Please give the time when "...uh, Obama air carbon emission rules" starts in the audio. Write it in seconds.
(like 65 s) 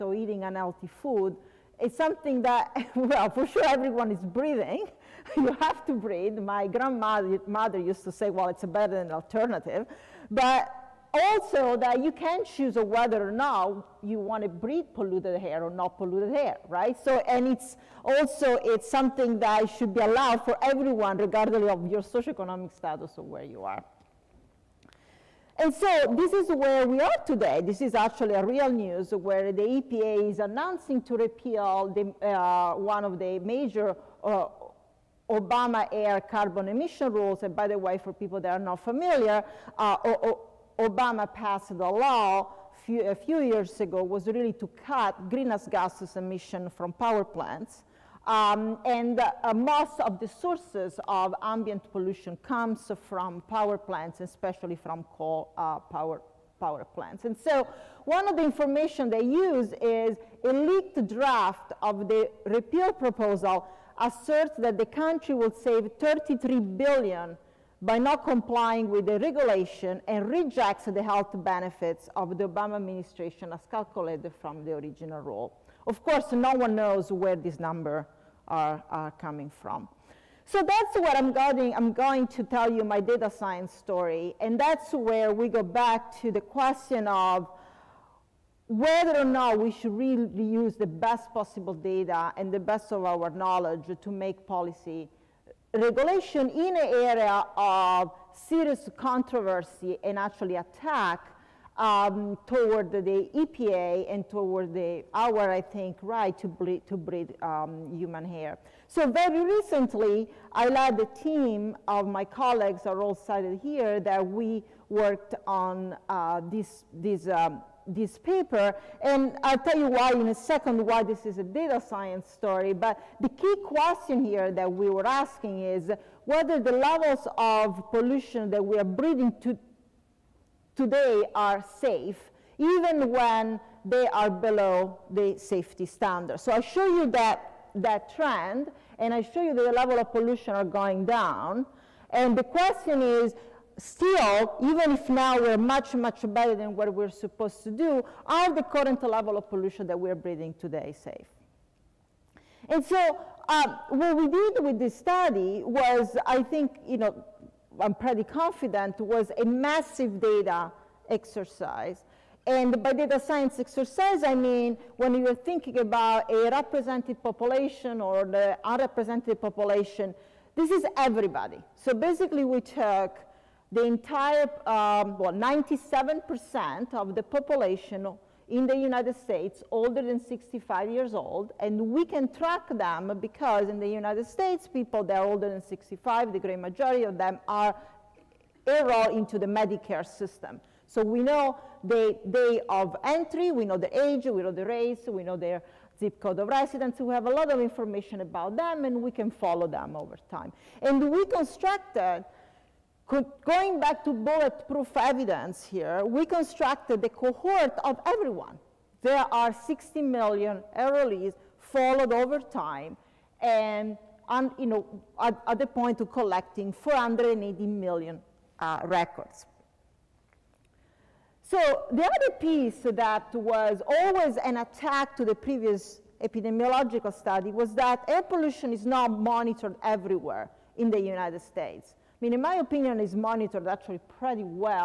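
34 s.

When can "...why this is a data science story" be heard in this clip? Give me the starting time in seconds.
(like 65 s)
120 s.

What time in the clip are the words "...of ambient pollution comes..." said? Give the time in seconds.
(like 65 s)
51 s.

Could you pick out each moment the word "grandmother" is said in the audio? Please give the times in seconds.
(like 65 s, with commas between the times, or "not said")
6 s.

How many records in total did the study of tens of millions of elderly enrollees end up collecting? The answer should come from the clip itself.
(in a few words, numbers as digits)
480 million.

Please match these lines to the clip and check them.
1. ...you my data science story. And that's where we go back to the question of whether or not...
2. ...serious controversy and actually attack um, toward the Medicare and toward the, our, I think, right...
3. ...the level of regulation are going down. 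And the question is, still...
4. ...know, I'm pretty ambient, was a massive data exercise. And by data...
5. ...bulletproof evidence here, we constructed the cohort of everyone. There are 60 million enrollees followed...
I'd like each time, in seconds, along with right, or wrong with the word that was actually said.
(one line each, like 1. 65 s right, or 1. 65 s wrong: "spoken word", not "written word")
1. 82 s right
2. 98 s wrong: "EPA", not "Medicare"
3. 139 s wrong: "pollution", not "regulation"
4. 156 s wrong: "confident", not "ambient"
5. 204 s right.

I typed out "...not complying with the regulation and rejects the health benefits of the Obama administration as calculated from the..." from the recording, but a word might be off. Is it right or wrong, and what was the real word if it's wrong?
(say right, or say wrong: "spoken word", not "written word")
right.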